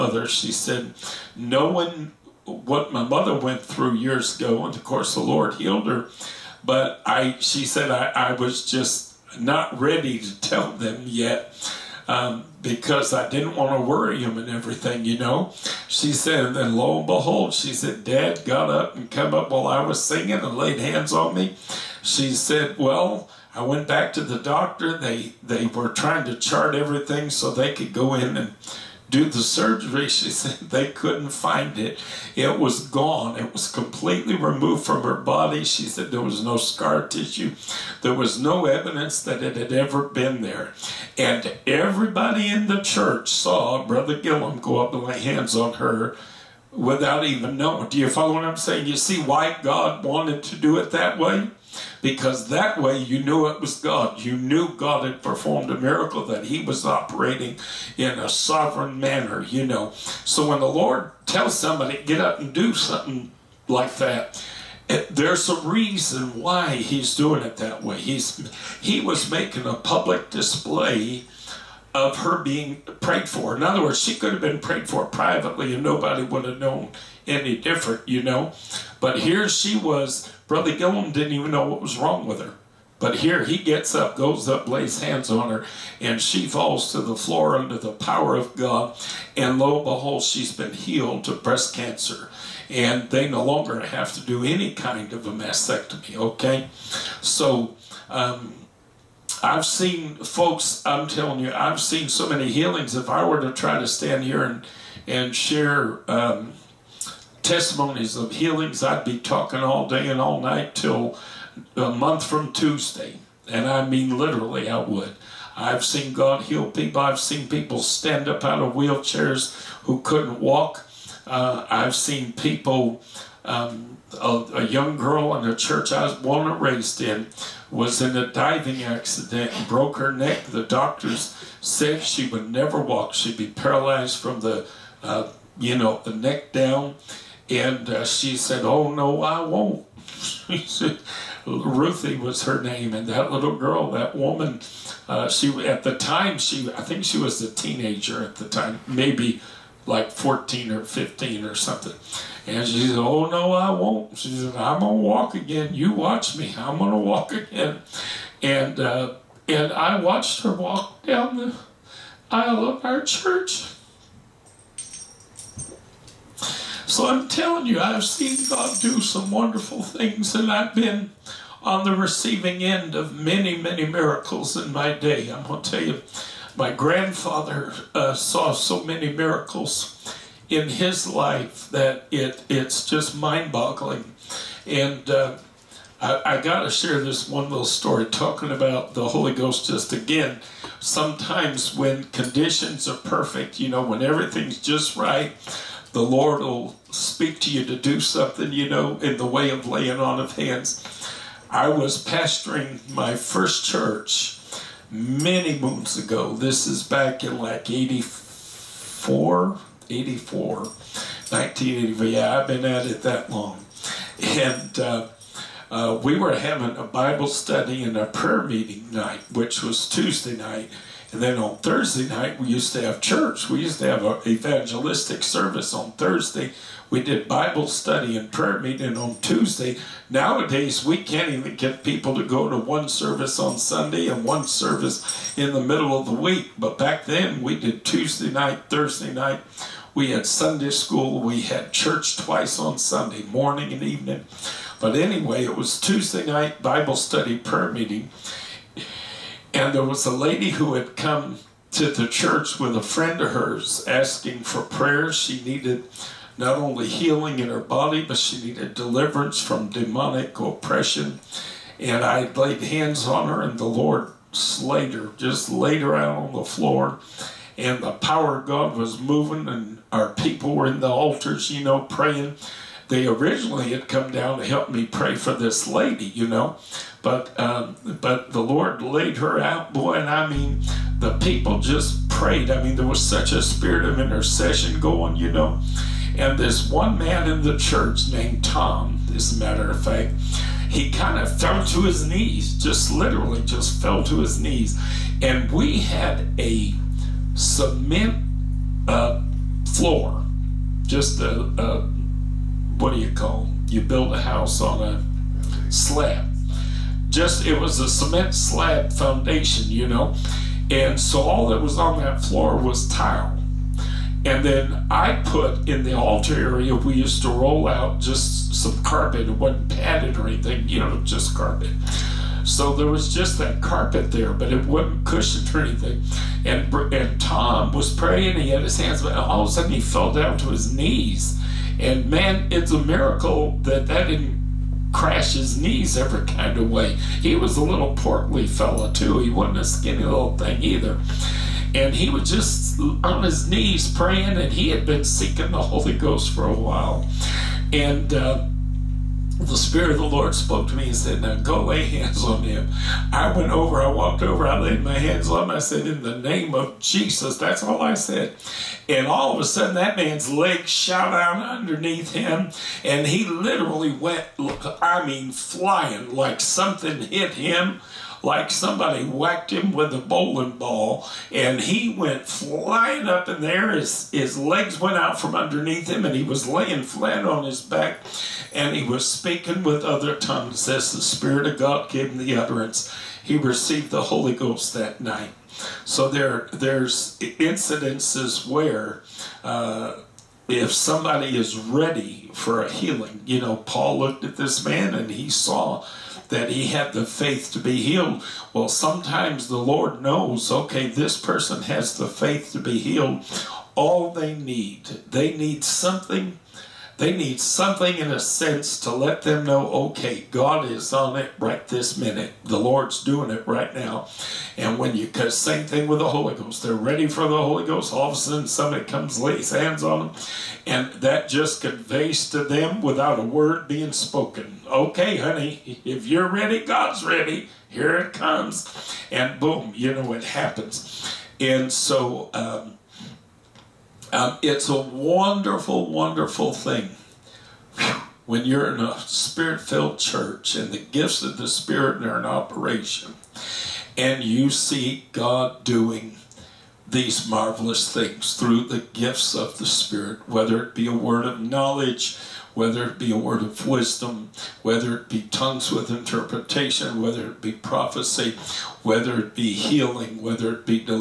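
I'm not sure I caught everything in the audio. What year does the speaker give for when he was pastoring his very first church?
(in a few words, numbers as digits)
1984.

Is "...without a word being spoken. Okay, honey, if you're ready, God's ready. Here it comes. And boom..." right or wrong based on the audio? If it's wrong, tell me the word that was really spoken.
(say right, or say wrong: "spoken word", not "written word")
right.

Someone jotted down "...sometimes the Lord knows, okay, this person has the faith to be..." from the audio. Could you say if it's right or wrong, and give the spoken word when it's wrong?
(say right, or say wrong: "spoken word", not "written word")
right.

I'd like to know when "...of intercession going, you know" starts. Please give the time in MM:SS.
04:43.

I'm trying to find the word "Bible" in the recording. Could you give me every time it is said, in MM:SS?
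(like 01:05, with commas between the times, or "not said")
03:36, 03:47, 04:06.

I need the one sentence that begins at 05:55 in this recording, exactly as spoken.
I said, In the name of Jesus.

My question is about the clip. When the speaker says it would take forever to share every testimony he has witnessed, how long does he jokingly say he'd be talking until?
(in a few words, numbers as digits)
a month from Tuesday.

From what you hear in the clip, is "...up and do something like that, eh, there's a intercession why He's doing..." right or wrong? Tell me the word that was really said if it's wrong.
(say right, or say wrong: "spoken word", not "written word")
wrong: "reason", not "intercession".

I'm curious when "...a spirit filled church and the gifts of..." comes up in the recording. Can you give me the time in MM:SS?
07:18.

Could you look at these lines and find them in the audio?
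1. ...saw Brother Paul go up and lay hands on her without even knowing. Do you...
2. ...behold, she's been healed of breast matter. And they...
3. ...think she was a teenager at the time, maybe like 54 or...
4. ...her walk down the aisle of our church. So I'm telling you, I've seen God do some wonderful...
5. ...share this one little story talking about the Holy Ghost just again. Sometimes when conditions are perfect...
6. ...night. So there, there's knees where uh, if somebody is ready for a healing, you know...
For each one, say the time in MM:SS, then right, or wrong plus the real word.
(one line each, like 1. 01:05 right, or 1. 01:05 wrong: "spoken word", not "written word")
1. 00:43 wrong: "Gillum", not "Paul"
2. 01:29 wrong: "cancer", not "matter"
3. 02:26 wrong: "14", not "54"
4. 02:40 right
5. 03:06 right
6. 06:24 wrong: "incidences", not "knees".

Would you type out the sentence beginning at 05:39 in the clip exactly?
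He wasn't a skinny little thing either.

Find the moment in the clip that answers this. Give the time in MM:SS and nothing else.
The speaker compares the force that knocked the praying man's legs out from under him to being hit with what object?
06:09.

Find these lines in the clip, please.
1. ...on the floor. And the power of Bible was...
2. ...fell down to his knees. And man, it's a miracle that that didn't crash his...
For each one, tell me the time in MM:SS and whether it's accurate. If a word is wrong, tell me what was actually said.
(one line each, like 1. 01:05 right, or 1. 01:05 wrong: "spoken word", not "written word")
1. 04:26 wrong: "God", not "Bible"
2. 05:29 right.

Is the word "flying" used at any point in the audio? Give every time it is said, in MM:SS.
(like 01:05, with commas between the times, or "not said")
06:05, 06:12.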